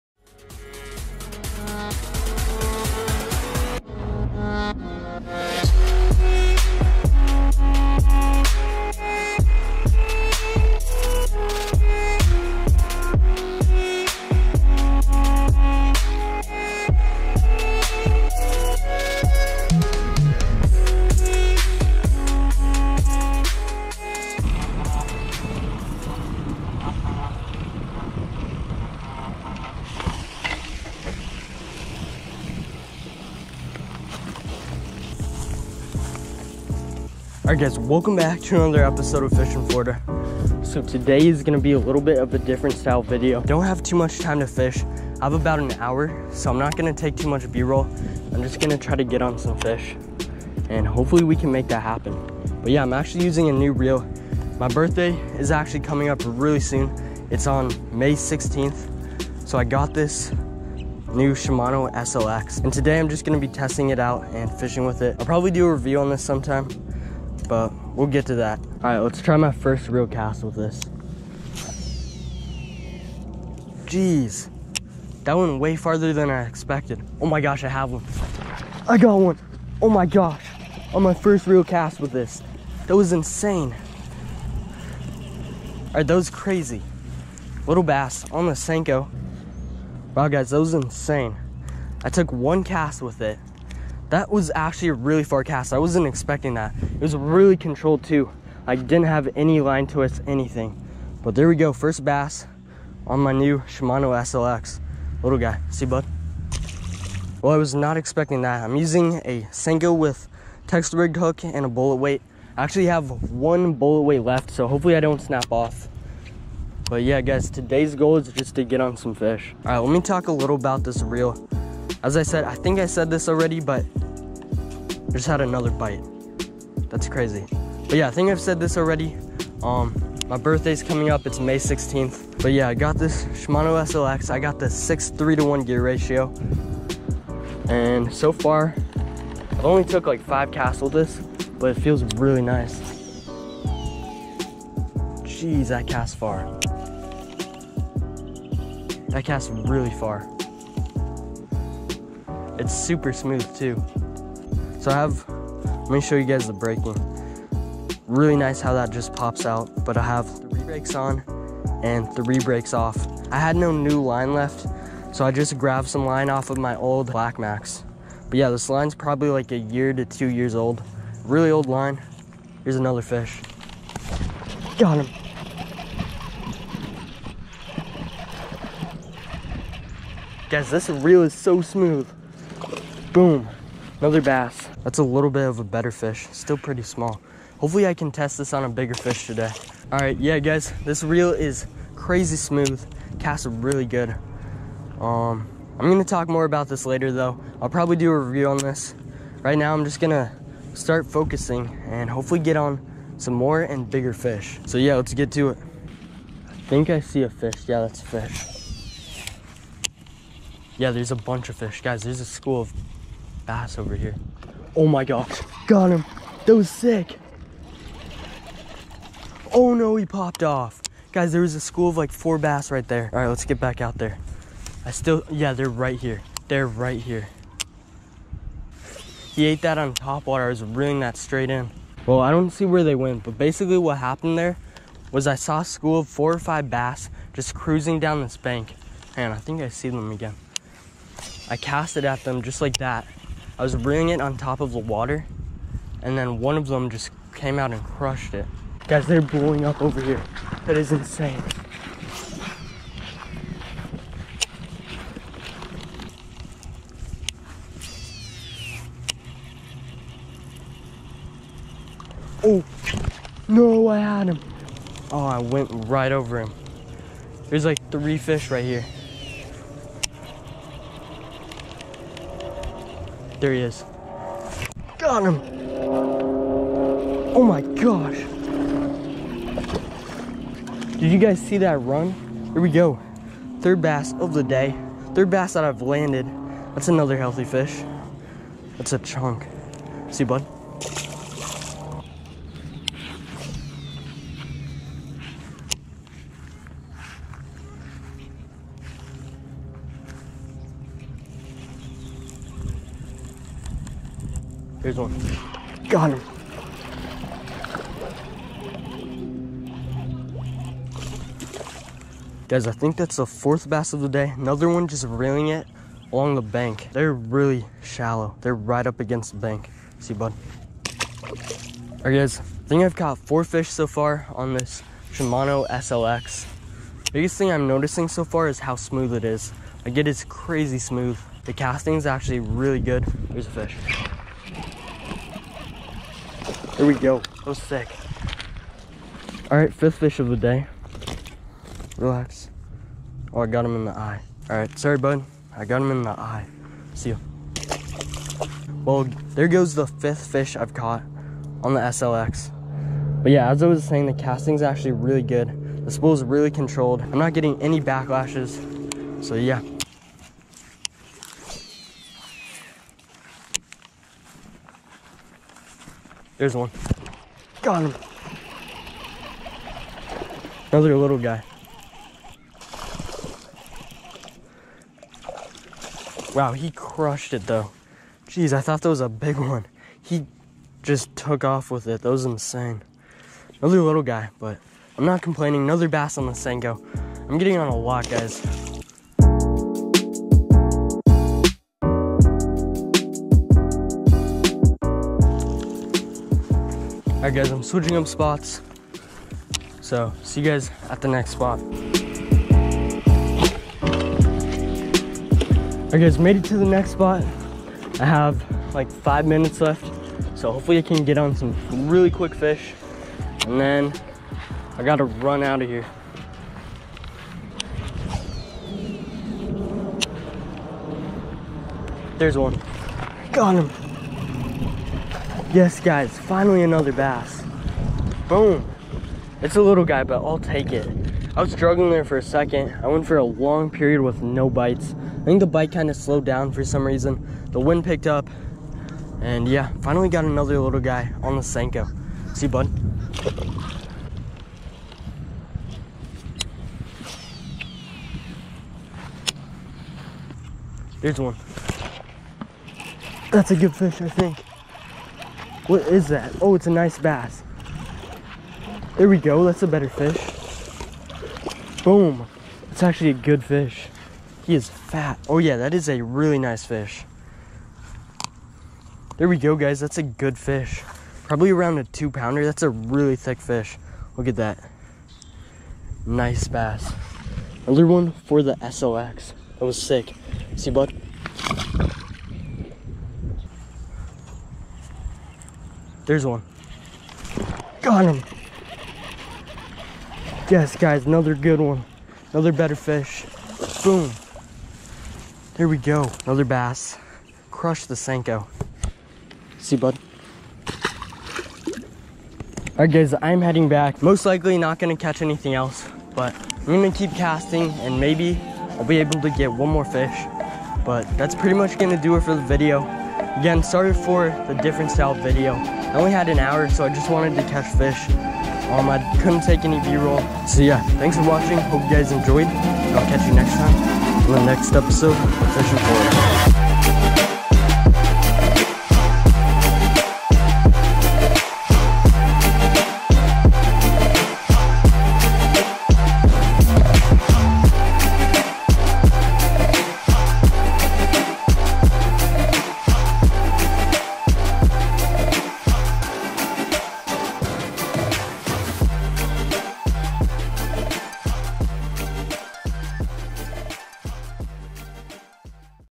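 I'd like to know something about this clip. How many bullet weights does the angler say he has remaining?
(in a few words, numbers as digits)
1.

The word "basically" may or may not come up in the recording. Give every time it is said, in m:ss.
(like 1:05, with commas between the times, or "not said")
3:53.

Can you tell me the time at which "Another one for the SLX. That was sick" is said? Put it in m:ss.
7:57.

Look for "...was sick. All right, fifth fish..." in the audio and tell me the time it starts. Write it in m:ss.
5:37.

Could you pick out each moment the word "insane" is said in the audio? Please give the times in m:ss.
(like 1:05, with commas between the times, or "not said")
1:23, 1:30, 4:10, 6:22.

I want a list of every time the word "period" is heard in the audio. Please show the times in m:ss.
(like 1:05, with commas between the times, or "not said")
7:13.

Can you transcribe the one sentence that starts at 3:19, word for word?
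Right now I'm just gonna start focusing and hopefully get on some more and bigger fish.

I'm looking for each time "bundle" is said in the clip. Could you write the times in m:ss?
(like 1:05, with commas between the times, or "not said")
not said.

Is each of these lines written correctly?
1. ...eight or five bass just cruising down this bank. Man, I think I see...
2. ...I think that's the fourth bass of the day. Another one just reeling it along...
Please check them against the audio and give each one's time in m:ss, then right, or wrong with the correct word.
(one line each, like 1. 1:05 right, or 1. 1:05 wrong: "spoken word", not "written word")
1. 3:56 wrong: "four", not "eight"
2. 5:12 right.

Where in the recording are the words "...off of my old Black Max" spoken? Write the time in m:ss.
2:46.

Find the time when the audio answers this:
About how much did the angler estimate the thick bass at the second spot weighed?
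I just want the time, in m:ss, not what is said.
7:51.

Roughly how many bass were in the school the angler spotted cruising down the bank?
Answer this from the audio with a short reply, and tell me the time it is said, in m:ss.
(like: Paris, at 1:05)
4, at 3:42.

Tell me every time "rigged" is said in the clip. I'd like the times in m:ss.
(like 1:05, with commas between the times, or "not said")
1:50.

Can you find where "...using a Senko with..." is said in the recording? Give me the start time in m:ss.
1:48.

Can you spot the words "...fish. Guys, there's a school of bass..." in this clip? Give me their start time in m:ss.
3:31.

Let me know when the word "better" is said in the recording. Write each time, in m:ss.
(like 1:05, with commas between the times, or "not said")
3:05, 7:39, 8:12.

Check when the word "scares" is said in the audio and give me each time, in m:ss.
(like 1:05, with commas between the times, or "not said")
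not said.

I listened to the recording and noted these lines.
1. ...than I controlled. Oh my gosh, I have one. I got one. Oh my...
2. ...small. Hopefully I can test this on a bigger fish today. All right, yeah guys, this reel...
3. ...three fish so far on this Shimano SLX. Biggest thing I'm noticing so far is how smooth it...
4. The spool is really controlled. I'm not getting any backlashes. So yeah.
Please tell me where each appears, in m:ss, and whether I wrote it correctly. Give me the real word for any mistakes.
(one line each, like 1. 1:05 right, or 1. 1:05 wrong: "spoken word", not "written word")
1. 1:16 wrong: "expected", not "controlled"
2. 3:06 right
3. 5:23 wrong: "four", not "three"
4. 5:55 right.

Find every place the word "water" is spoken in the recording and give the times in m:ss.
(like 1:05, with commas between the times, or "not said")
3:50, 4:04.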